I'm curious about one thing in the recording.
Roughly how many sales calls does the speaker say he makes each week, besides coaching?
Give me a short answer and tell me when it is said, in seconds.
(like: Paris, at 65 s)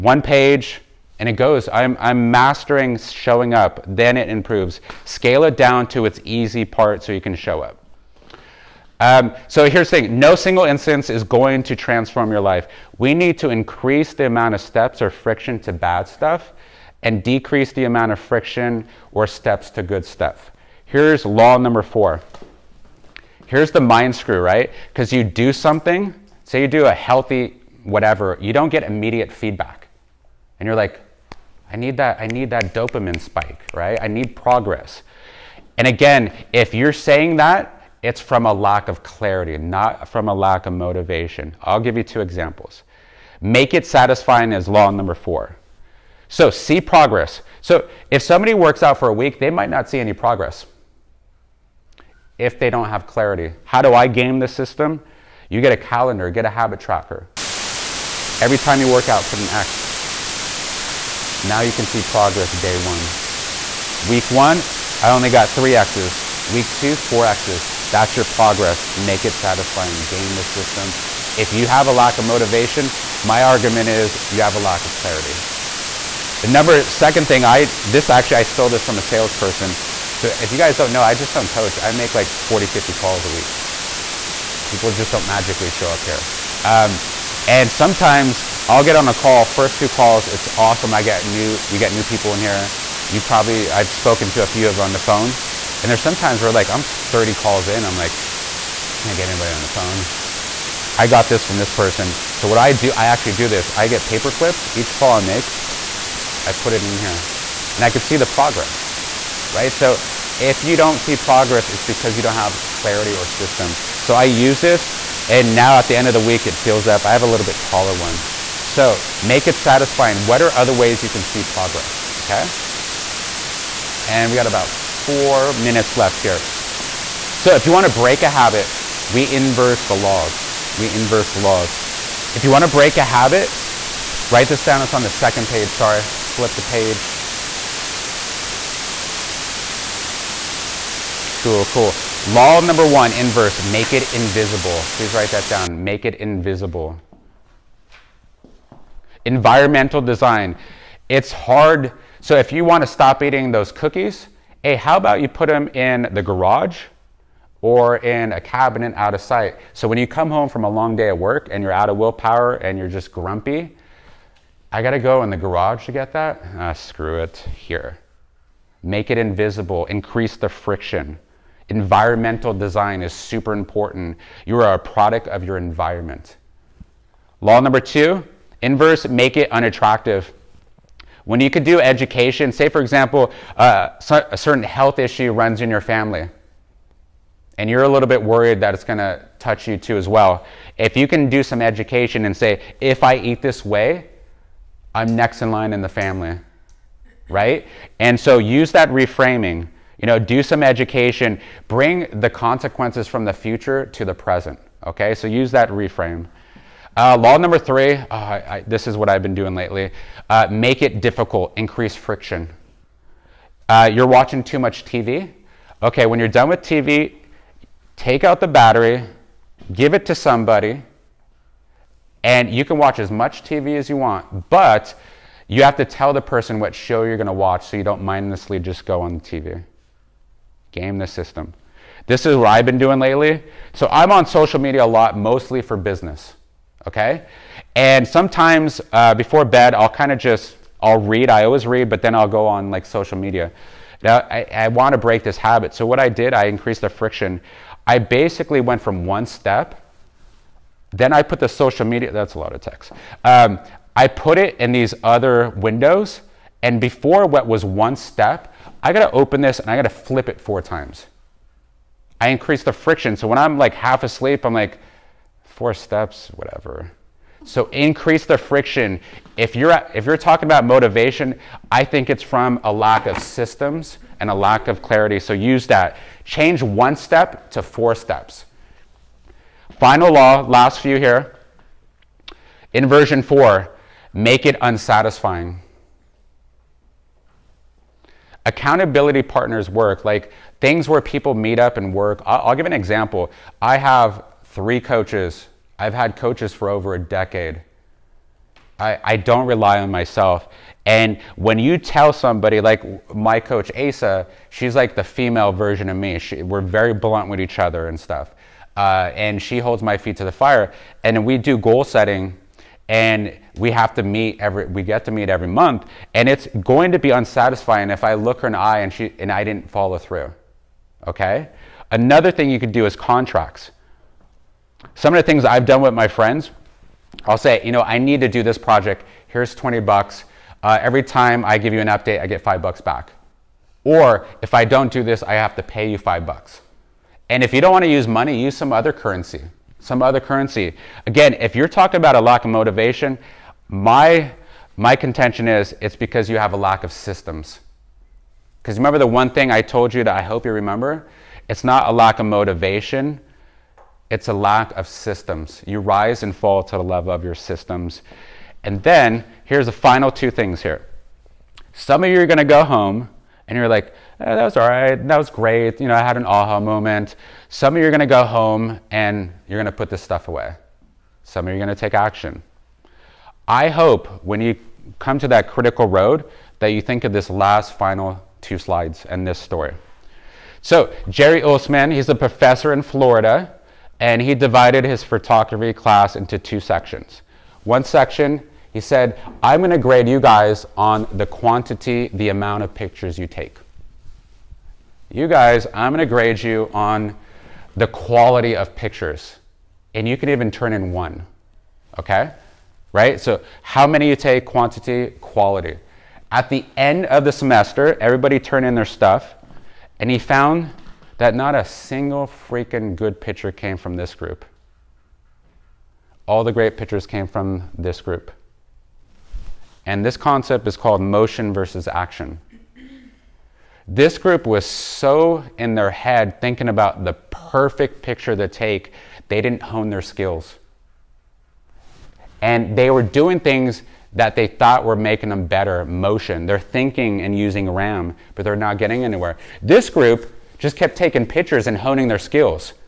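40 to 50, at 82 s.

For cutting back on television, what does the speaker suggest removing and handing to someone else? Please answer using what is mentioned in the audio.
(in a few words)
The battery.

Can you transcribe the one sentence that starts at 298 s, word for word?
I, I don't rely on myself.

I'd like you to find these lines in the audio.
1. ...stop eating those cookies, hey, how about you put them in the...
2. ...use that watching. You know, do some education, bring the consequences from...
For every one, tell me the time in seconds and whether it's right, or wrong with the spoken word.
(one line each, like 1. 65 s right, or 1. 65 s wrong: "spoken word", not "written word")
1. 152 s right
2. 198 s wrong: "reframing", not "watching".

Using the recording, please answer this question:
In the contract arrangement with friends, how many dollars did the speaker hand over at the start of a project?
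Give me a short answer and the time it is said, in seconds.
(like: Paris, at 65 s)
20, at 329 s.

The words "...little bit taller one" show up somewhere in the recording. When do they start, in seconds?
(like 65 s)
117 s.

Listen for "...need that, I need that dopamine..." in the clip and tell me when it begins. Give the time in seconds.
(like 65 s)
31 s.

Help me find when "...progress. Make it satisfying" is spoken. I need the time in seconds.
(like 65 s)
68 s.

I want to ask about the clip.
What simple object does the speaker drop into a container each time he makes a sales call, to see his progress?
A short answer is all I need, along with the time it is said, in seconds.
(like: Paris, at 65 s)
Paper clips, at 104 s.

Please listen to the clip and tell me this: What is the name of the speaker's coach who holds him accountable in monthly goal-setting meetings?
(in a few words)
Asa.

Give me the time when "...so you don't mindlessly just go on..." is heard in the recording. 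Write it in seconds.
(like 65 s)
227 s.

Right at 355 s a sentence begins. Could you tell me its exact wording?
You rise and fall to the level of your systems.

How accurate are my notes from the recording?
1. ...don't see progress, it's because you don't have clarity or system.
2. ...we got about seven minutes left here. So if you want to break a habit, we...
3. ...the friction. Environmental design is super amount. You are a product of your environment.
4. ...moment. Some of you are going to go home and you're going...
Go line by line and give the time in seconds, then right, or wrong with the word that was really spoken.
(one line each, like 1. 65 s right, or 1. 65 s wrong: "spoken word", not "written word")
1. 110 s right
2. 124 s wrong: "four", not "seven"
3. 170 s wrong: "important", not "amount"
4. 366 s right.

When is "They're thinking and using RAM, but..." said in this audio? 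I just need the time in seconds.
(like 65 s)
436 s.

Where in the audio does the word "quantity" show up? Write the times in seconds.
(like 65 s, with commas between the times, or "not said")
391 s, 404 s.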